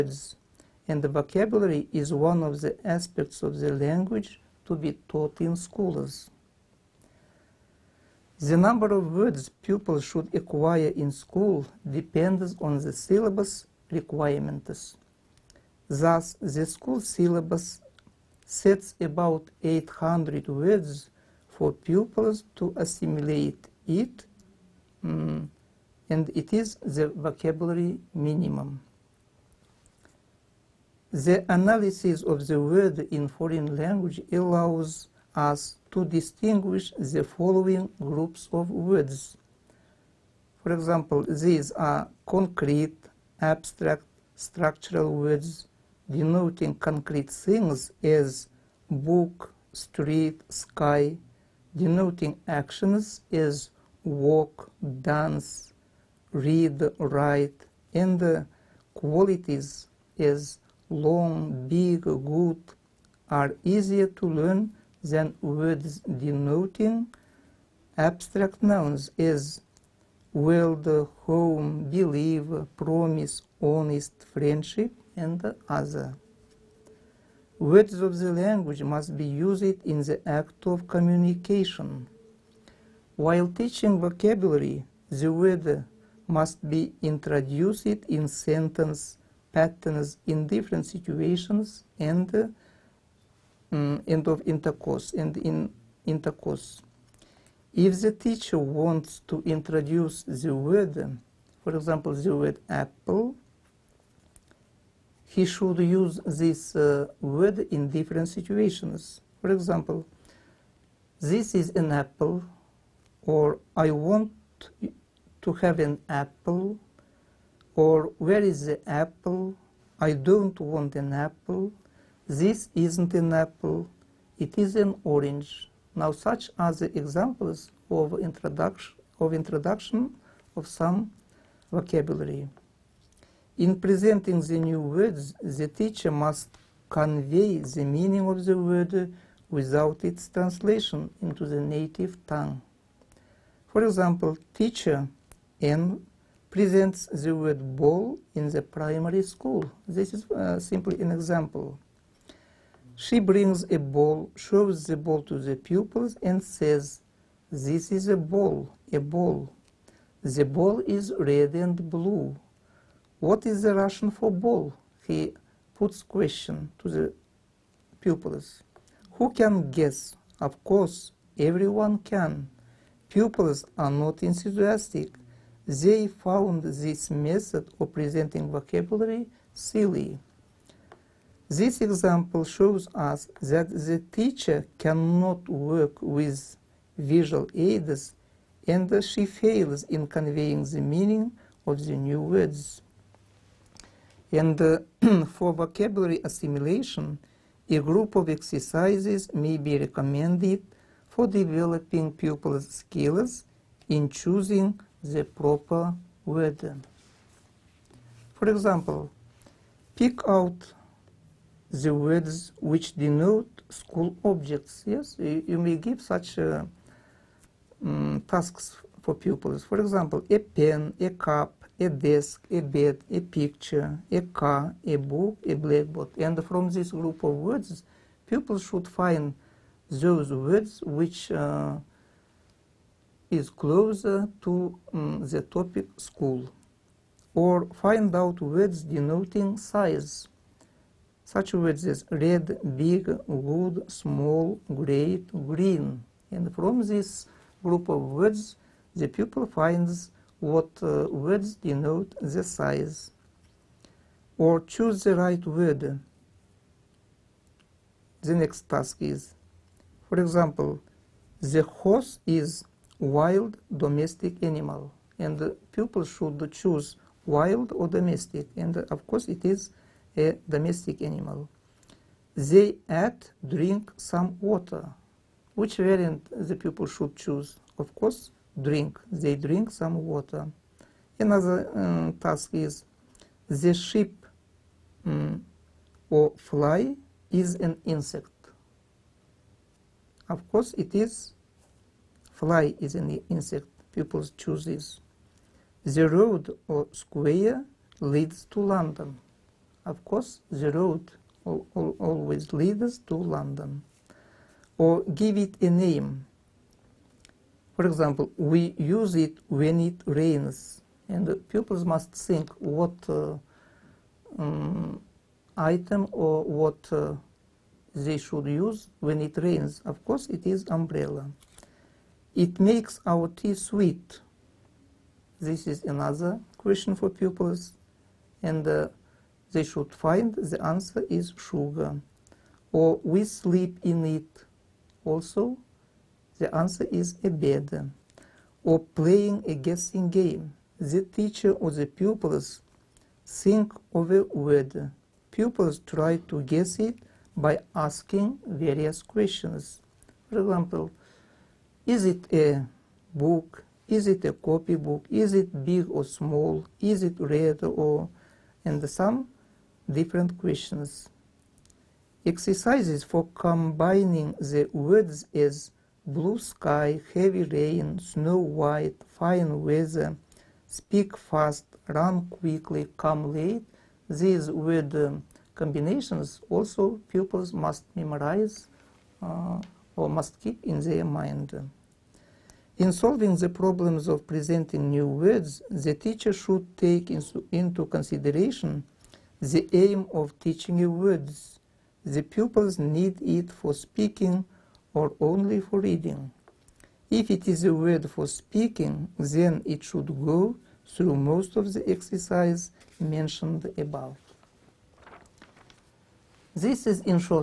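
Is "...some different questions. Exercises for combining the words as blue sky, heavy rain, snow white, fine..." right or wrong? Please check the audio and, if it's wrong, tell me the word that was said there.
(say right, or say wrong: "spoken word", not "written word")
right.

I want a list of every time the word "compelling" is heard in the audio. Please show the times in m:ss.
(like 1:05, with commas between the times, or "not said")
not said.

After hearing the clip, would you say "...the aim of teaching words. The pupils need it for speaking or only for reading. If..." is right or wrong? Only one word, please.
right.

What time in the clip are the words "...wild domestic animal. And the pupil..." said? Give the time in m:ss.
4:22.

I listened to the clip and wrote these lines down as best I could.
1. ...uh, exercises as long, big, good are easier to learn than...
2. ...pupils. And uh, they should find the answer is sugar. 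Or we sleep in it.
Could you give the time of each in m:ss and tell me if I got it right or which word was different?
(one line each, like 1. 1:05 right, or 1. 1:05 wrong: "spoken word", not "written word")
1. 0:58 wrong: "qualities", not "exercises"
2. 5:27 right.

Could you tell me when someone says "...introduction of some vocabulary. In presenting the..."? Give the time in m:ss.
2:09.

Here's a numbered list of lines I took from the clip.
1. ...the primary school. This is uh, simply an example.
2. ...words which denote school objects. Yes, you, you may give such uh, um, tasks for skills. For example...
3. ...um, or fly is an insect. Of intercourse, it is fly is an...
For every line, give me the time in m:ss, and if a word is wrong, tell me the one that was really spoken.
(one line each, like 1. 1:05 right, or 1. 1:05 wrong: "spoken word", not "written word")
1. 2:28 right
2. 3:31 wrong: "pupils", not "skills"
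3. 4:45 wrong: "course", not "intercourse".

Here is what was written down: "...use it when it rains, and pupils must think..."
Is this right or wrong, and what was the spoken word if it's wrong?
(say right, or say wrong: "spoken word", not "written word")
right.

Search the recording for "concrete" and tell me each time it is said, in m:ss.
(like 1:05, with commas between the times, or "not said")
0:42, 0:46.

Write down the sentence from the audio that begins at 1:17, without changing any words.
Words of the language must be used in the act of communication.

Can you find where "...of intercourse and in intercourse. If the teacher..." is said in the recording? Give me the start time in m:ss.
1:34.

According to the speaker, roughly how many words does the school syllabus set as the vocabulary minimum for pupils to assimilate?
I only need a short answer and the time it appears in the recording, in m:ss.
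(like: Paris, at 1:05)
800, at 0:19.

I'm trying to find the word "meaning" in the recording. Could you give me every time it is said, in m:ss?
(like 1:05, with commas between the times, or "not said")
2:17, 3:10.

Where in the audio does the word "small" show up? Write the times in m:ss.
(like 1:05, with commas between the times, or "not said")
4:03, 5:56.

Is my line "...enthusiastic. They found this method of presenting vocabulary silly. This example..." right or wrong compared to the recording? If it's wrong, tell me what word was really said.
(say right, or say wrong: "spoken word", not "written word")
right.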